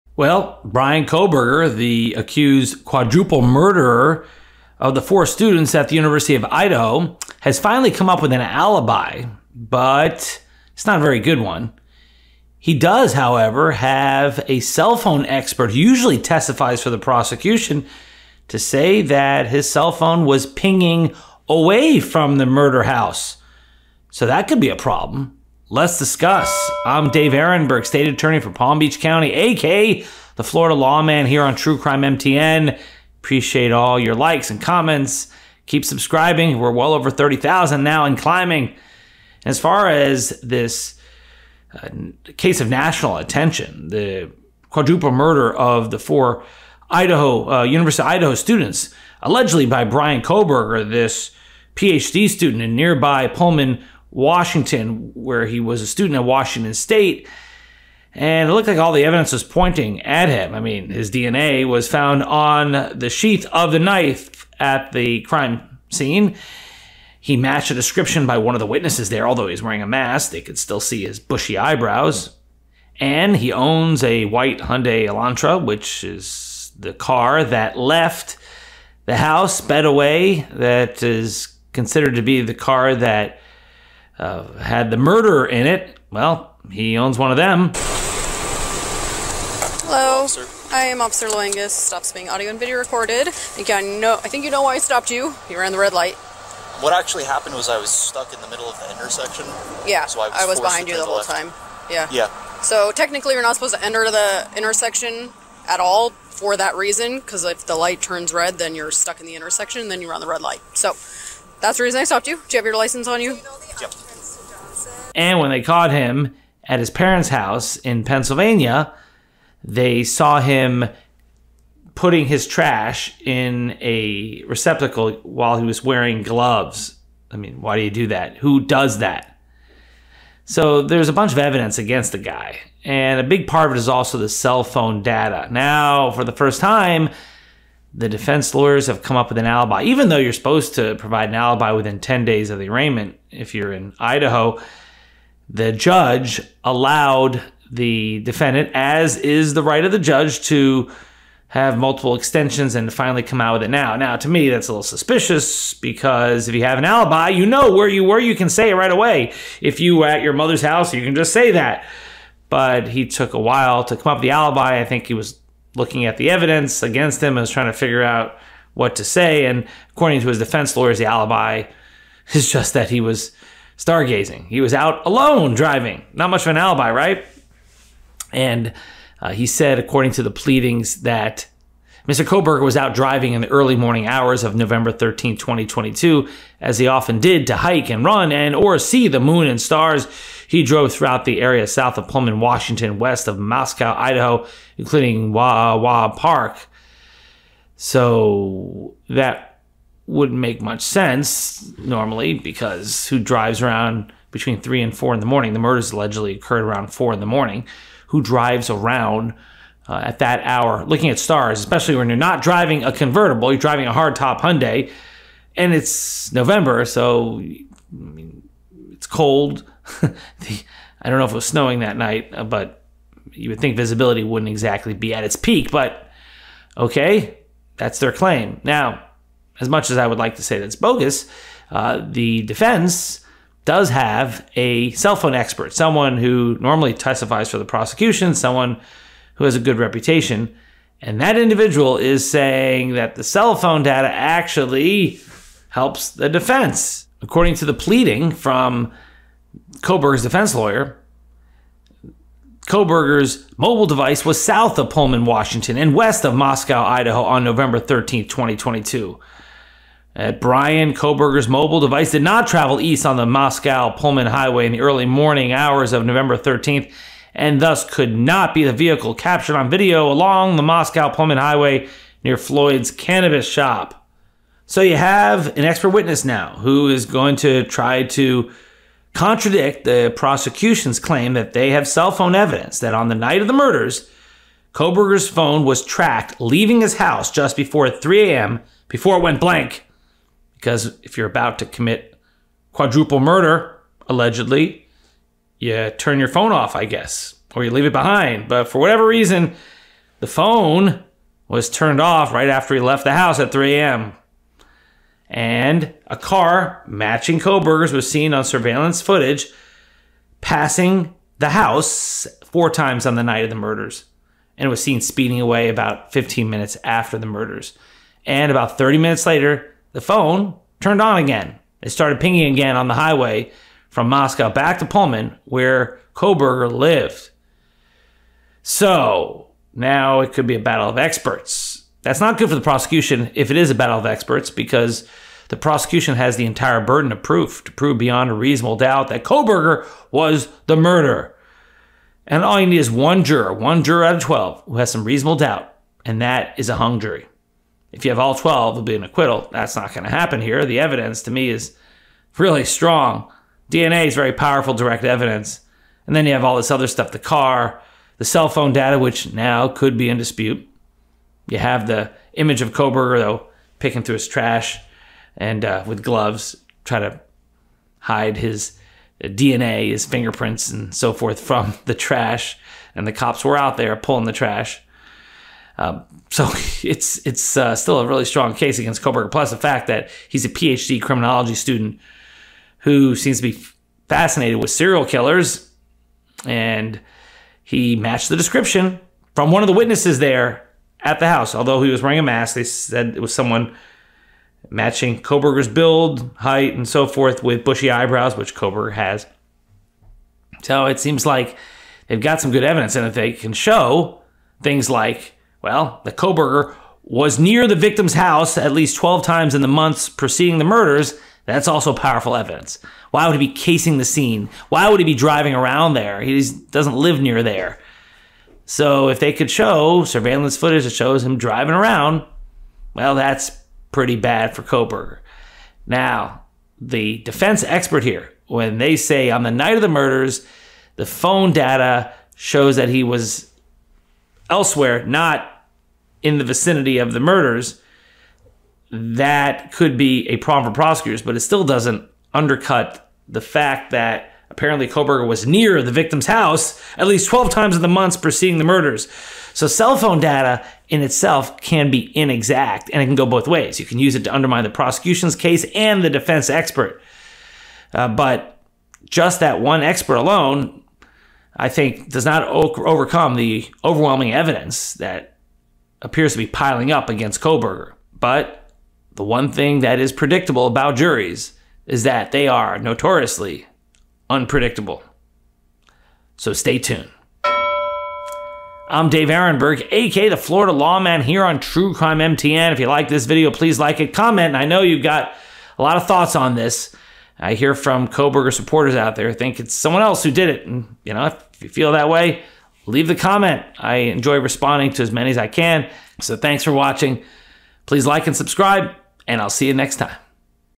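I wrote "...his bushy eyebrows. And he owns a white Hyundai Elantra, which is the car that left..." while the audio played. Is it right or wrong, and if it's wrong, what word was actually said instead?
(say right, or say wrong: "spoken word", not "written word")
right.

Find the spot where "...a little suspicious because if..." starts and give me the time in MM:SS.
02:34.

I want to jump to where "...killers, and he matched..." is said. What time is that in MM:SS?
06:25.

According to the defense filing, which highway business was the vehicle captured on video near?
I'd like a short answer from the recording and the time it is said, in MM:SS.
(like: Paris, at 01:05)
Floyd's cannabis shop, at 04:32.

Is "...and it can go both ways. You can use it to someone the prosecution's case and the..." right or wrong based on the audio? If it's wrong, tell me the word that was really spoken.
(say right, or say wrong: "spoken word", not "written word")
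wrong: "undermine", not "someone".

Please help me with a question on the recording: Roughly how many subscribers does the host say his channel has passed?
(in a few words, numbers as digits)
30,000.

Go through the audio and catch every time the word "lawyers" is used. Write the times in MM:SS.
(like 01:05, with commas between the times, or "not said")
02:18, 02:50, 04:10.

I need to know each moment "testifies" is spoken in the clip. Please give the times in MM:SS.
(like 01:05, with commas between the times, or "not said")
00:16, 03:56.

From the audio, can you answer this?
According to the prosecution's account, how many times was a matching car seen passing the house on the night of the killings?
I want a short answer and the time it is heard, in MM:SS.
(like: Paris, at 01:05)
4, at 05:12.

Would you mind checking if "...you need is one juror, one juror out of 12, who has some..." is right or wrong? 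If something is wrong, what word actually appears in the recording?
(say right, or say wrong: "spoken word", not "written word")
right.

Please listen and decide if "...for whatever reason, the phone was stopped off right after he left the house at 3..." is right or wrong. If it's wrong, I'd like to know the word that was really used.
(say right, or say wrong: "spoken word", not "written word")
wrong: "turned", not "stopped".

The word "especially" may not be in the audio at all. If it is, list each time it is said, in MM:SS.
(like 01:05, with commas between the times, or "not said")
03:31.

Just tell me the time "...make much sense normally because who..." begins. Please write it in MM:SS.
03:20.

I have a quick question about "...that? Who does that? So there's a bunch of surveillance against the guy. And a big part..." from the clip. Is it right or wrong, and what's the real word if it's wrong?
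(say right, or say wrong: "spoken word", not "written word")
wrong: "evidence", not "surveillance".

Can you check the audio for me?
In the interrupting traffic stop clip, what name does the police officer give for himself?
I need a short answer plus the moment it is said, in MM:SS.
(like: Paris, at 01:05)
Officer Loengus, at 01:31.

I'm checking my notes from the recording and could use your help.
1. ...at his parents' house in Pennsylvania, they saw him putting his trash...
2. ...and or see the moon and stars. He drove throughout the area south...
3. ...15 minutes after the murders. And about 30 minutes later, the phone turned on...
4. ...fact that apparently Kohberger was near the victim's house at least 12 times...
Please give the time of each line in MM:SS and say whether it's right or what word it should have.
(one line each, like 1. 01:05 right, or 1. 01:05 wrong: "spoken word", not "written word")
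1. 01:56 right
2. 03:08 right
3. 05:16 right
4. 07:23 right.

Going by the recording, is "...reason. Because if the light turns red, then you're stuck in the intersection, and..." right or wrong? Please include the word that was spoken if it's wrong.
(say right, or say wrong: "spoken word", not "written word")
right.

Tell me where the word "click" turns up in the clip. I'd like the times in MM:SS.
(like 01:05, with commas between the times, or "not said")
not said.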